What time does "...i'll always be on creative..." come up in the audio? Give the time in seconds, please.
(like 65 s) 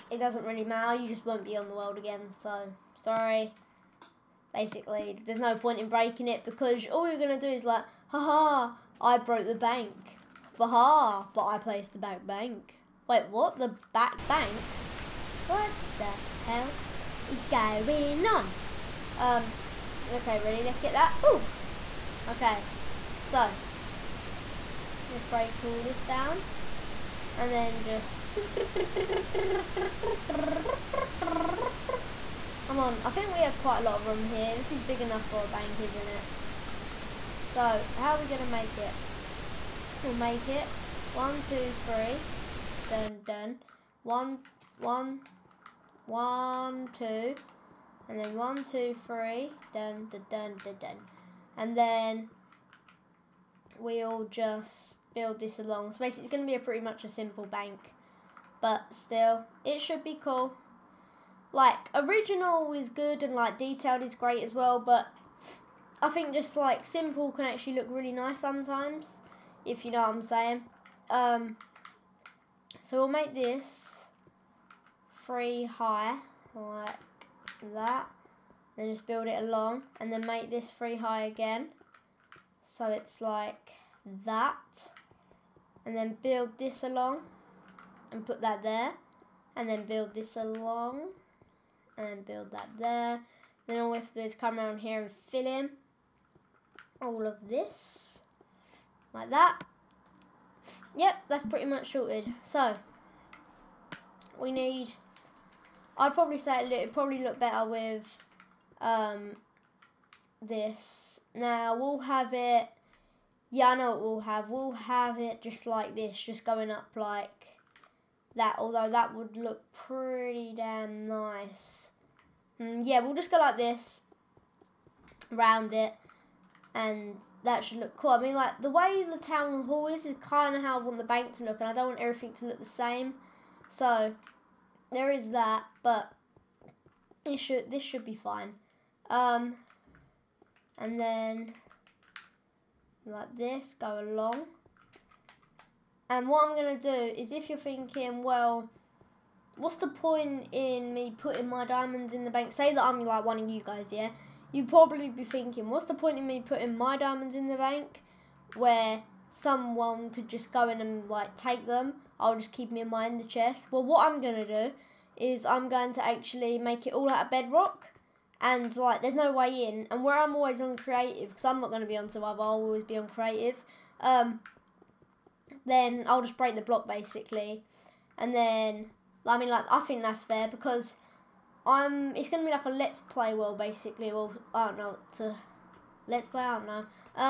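172 s.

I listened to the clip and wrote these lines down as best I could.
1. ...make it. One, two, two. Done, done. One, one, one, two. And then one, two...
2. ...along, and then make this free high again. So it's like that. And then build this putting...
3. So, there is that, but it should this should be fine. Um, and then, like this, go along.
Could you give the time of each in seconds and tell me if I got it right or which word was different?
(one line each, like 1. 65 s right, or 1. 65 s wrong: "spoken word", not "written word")
1. 40 s wrong: "three", not "two"
2. 79 s wrong: "along", not "putting"
3. 133 s right.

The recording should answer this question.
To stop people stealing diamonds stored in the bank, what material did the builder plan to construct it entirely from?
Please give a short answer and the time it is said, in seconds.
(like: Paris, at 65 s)
Bedrock, at 167 s.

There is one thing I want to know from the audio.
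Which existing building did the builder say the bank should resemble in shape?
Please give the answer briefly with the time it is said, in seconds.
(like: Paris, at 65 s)
The town hall, at 129 s.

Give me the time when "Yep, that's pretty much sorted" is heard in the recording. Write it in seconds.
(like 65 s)
100 s.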